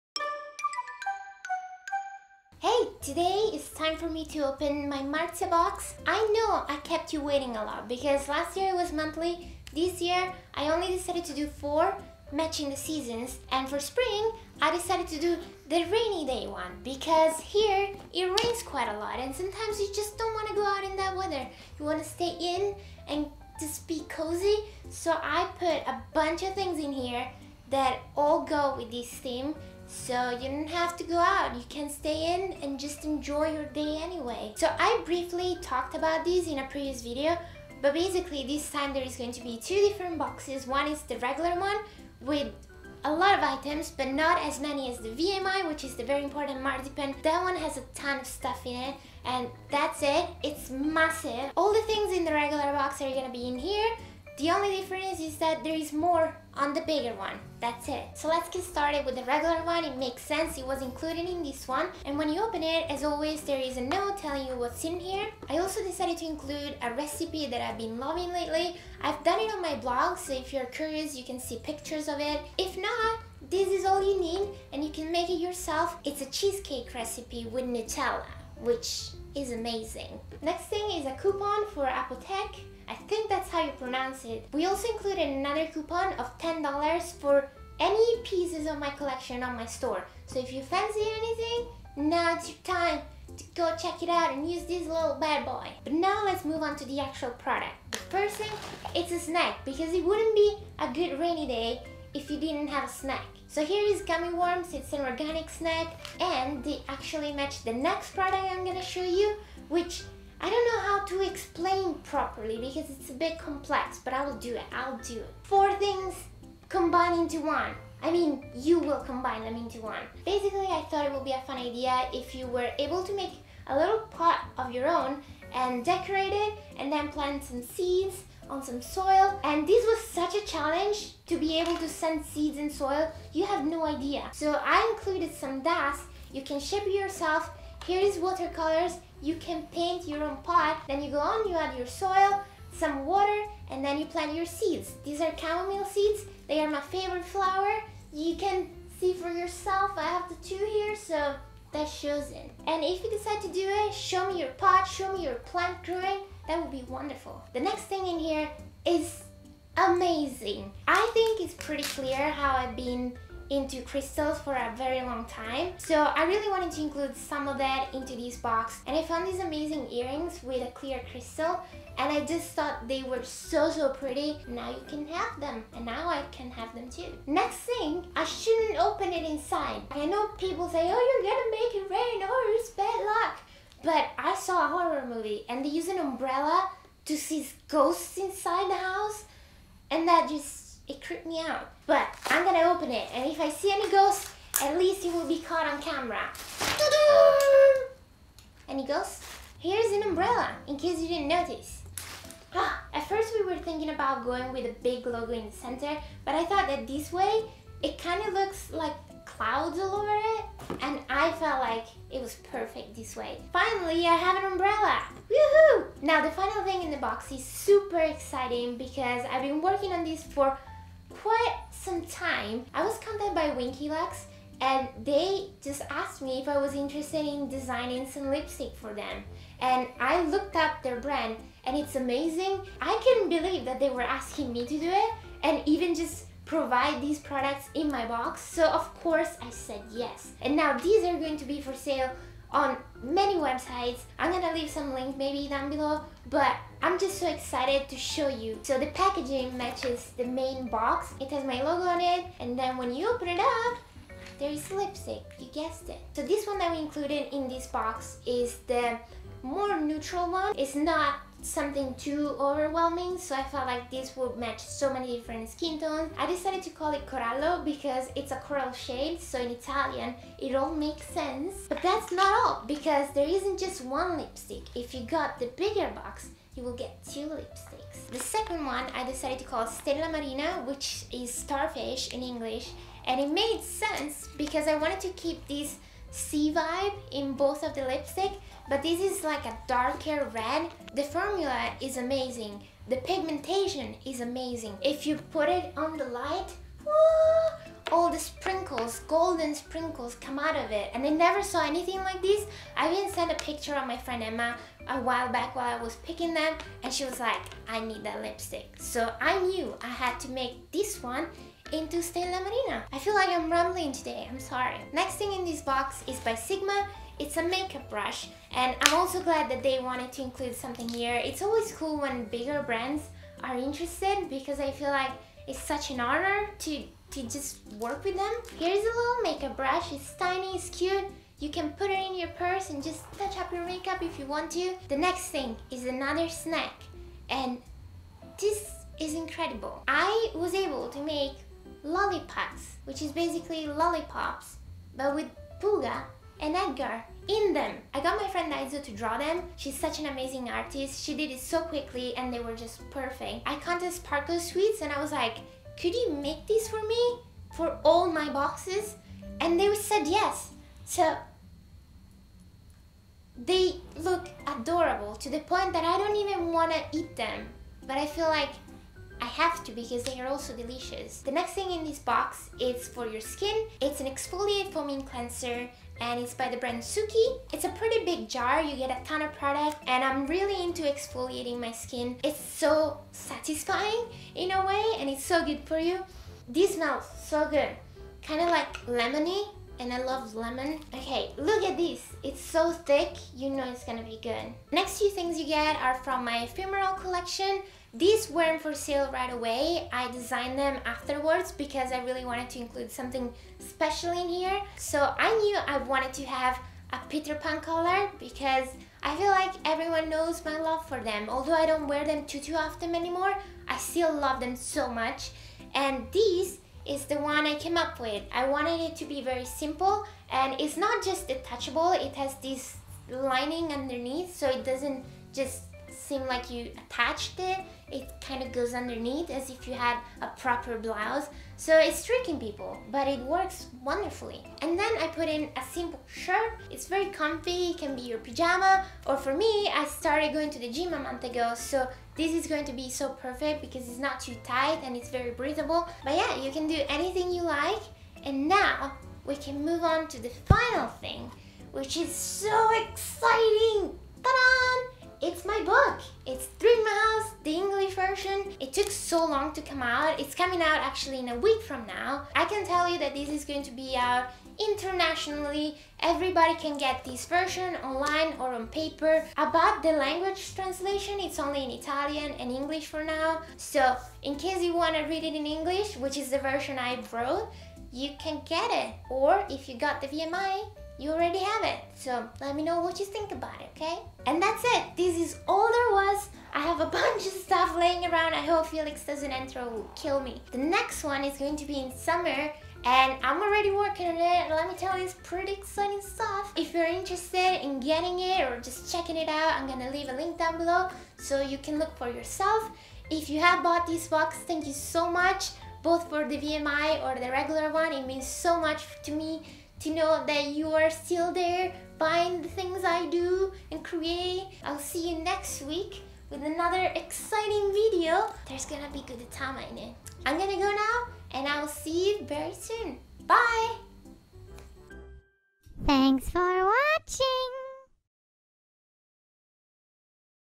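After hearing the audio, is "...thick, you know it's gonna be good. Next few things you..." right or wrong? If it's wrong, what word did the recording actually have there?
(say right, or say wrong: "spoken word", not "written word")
right.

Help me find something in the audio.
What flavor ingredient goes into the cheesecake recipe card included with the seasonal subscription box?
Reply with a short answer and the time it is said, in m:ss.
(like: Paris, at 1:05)
Nutella, at 1:17.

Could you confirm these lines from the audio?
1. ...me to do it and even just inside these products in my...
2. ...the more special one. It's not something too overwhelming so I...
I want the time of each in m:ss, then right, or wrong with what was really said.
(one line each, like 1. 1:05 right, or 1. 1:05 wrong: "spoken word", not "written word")
1. 3:54 wrong: "provide", not "inside"
2. 4:18 wrong: "neutral", not "special".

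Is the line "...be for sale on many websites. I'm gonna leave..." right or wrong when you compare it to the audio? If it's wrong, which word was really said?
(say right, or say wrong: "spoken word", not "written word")
right.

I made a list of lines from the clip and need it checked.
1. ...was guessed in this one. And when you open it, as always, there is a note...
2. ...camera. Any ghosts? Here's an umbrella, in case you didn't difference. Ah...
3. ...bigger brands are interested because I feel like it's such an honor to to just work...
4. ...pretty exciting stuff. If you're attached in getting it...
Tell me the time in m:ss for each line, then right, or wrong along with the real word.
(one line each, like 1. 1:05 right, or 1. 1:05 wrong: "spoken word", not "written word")
1. 1:00 wrong: "included", not "guessed"
2. 3:15 wrong: "notice", not "difference"
3. 5:22 right
4. 8:15 wrong: "interested", not "attached".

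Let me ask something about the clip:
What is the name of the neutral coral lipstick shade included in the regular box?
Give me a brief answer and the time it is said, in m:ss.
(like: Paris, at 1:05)
Corallo, at 4:27.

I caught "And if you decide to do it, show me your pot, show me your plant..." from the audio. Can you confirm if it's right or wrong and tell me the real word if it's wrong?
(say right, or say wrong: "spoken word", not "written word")
right.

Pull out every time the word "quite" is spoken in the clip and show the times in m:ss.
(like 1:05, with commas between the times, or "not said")
0:18, 3:41.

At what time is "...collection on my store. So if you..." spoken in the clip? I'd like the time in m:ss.
1:28.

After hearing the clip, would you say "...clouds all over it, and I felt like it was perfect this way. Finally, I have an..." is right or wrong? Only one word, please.
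right.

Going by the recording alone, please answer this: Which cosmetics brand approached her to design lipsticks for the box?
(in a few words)
Winky Lux.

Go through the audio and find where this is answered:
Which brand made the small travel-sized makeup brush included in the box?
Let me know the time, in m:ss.
5:16.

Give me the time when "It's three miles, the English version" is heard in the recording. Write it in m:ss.
7:36.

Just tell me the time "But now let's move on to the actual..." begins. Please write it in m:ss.
1:35.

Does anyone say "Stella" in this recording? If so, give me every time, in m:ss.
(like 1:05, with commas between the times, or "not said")
4:39, 5:12.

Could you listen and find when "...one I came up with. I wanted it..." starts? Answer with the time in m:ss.
6:57.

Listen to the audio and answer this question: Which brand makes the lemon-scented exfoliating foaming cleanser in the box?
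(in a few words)
Suki.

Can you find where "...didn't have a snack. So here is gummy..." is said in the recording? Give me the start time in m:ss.
1:42.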